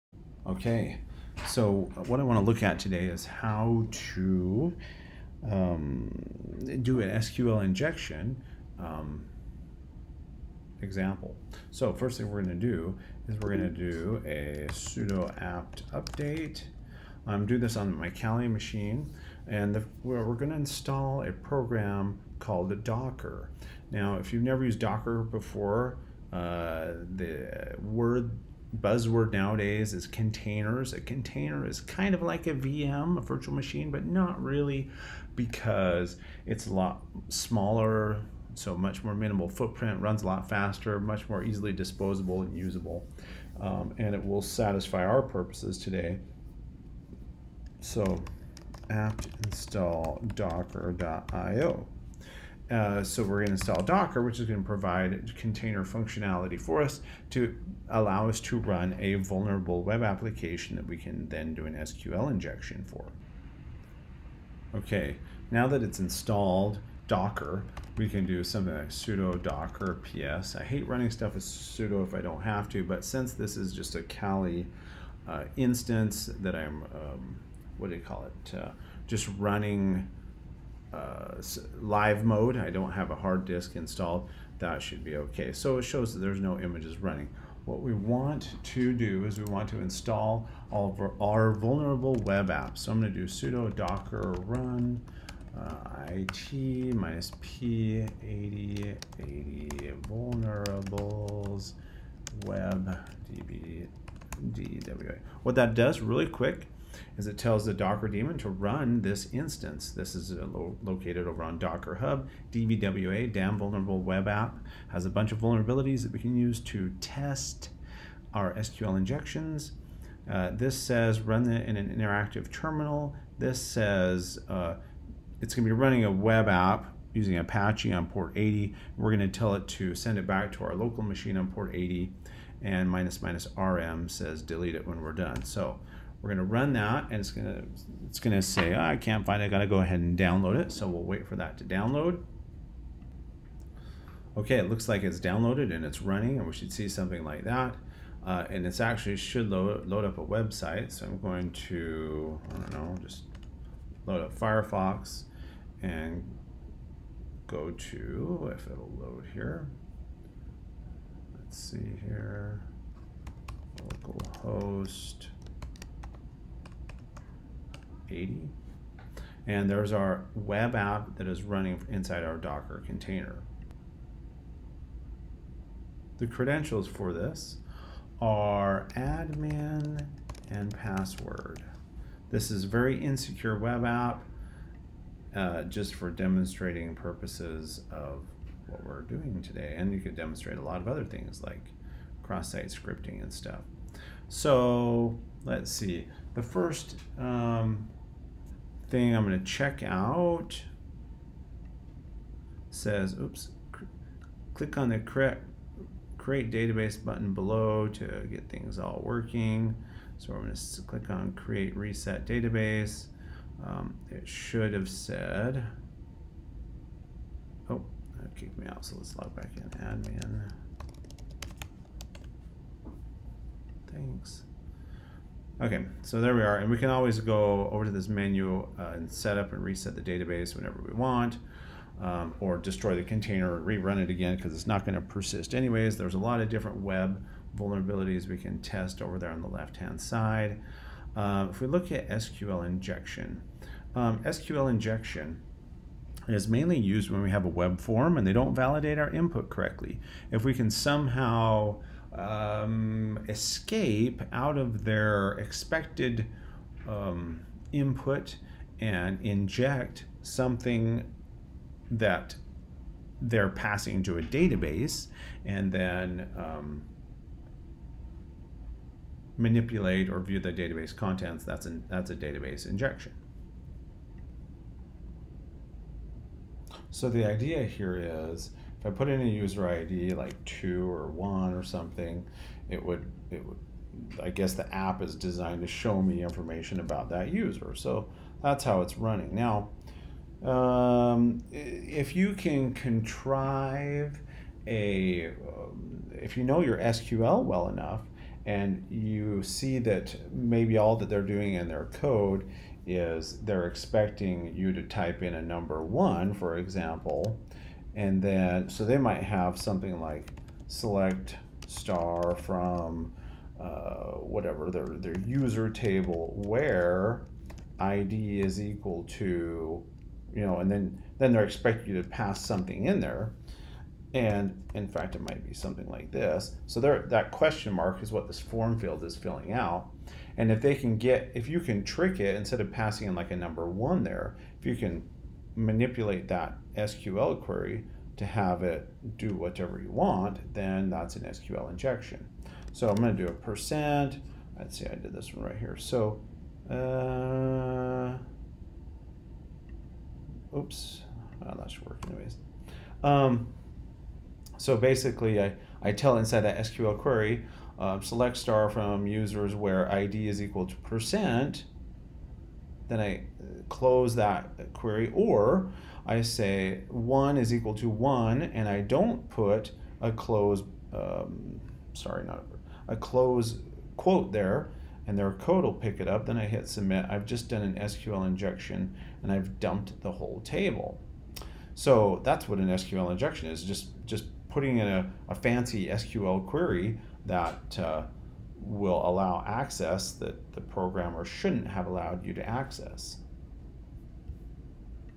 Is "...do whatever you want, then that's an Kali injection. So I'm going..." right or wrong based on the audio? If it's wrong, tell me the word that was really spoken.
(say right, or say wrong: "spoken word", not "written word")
wrong: "SQL", not "Kali".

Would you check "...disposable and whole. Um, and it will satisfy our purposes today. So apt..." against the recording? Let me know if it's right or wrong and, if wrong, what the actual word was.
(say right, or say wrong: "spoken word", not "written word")
wrong: "usable", not "whole".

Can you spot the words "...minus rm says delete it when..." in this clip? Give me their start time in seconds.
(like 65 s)
133 s.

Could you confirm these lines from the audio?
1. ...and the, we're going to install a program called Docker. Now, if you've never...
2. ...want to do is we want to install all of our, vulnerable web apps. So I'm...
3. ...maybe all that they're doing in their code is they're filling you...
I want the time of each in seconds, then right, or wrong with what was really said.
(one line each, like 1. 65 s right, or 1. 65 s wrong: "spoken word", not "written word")
1. 19 s right
2. 87 s right
3. 300 s wrong: "expecting", not "filling".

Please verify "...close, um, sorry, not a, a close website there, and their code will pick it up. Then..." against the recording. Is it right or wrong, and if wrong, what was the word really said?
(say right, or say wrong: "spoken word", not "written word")
wrong: "quote", not "website".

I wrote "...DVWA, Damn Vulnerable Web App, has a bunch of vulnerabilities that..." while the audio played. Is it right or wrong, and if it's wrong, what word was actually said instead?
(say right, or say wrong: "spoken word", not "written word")
right.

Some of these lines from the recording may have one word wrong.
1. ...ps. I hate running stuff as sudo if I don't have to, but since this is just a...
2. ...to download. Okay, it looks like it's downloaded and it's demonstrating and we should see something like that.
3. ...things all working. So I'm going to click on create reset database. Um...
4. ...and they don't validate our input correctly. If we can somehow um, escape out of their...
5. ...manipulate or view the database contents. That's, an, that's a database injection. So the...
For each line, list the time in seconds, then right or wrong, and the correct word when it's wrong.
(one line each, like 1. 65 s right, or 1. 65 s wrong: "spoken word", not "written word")
1. 70 s right
2. 141 s wrong: "running", not "demonstrating"
3. 208 s right
4. 248 s right
5. 269 s right.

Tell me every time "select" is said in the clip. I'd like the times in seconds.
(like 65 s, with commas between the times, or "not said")
310 s, 358 s.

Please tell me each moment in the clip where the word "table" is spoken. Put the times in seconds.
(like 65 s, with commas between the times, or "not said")
315 s, 380 s.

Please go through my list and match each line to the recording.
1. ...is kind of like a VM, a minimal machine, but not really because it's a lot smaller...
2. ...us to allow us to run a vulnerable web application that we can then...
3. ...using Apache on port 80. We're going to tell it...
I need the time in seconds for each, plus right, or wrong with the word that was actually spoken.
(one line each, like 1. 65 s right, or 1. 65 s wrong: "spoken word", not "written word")
1. 31 s wrong: "virtual", not "minimal"
2. 56 s right
3. 127 s right.